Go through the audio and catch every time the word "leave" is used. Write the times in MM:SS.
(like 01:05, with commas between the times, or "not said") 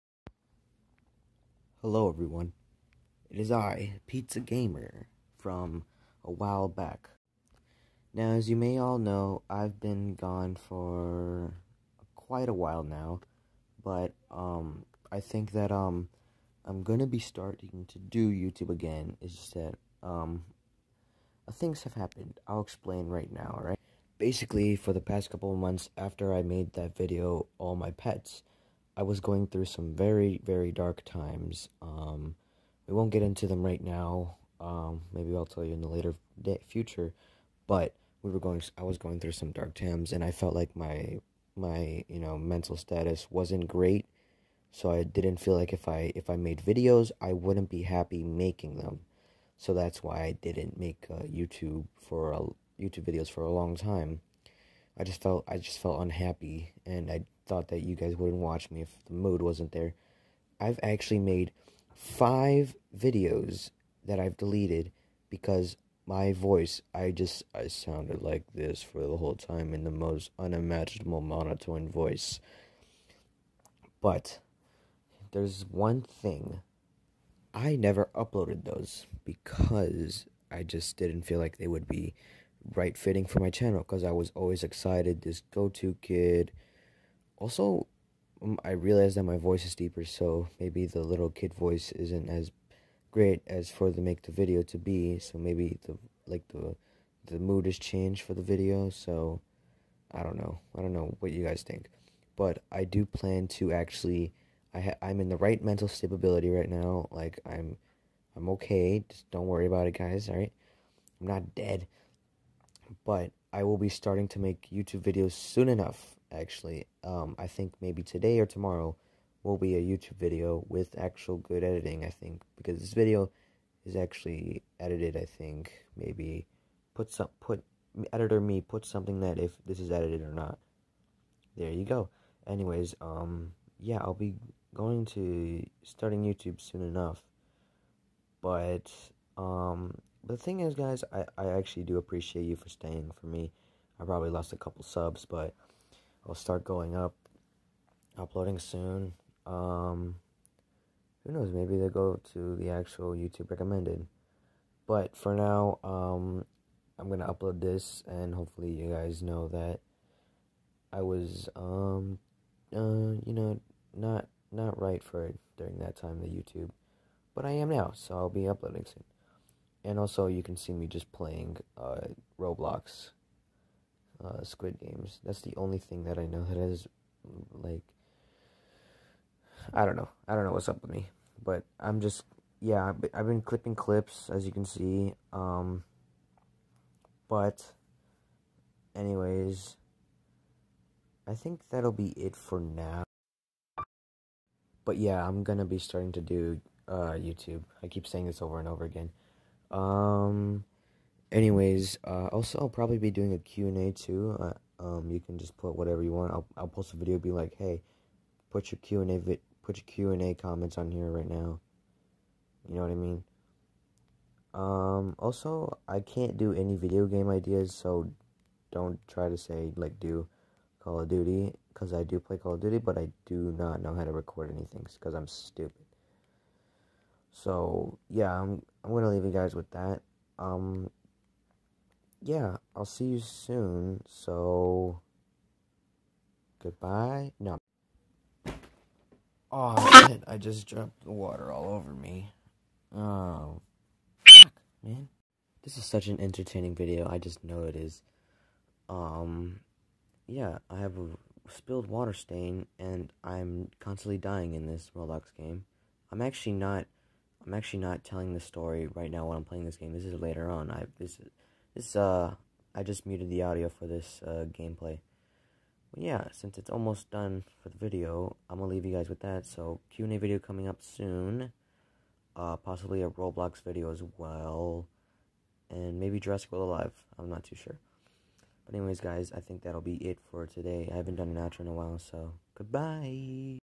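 03:49, 04:28.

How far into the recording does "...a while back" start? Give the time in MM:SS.
00:06.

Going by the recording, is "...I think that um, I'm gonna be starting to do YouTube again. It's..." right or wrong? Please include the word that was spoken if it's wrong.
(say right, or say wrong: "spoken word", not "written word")
right.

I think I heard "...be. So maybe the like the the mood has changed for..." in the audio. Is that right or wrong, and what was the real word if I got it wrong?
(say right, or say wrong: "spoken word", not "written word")
right.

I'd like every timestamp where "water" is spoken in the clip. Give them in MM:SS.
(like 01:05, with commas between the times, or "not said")
04:01, 04:11.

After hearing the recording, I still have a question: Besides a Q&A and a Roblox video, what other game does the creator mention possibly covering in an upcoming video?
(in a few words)
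Jurassic World Alive.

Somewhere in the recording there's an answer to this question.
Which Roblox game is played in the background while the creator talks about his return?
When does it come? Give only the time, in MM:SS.
02:54.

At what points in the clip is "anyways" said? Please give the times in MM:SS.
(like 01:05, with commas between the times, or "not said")
02:12, 03:08, 03:21, 04:38.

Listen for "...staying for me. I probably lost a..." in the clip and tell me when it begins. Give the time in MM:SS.
02:22.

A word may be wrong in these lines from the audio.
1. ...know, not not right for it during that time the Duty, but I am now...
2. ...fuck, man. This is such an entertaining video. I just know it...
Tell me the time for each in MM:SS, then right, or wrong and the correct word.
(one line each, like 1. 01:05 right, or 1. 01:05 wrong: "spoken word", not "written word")
1. 02:43 wrong: "YouTube", not "Duty"
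2. 04:04 right.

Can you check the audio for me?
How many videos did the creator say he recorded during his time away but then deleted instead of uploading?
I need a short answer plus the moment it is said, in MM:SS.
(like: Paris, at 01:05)
5, at 01:01.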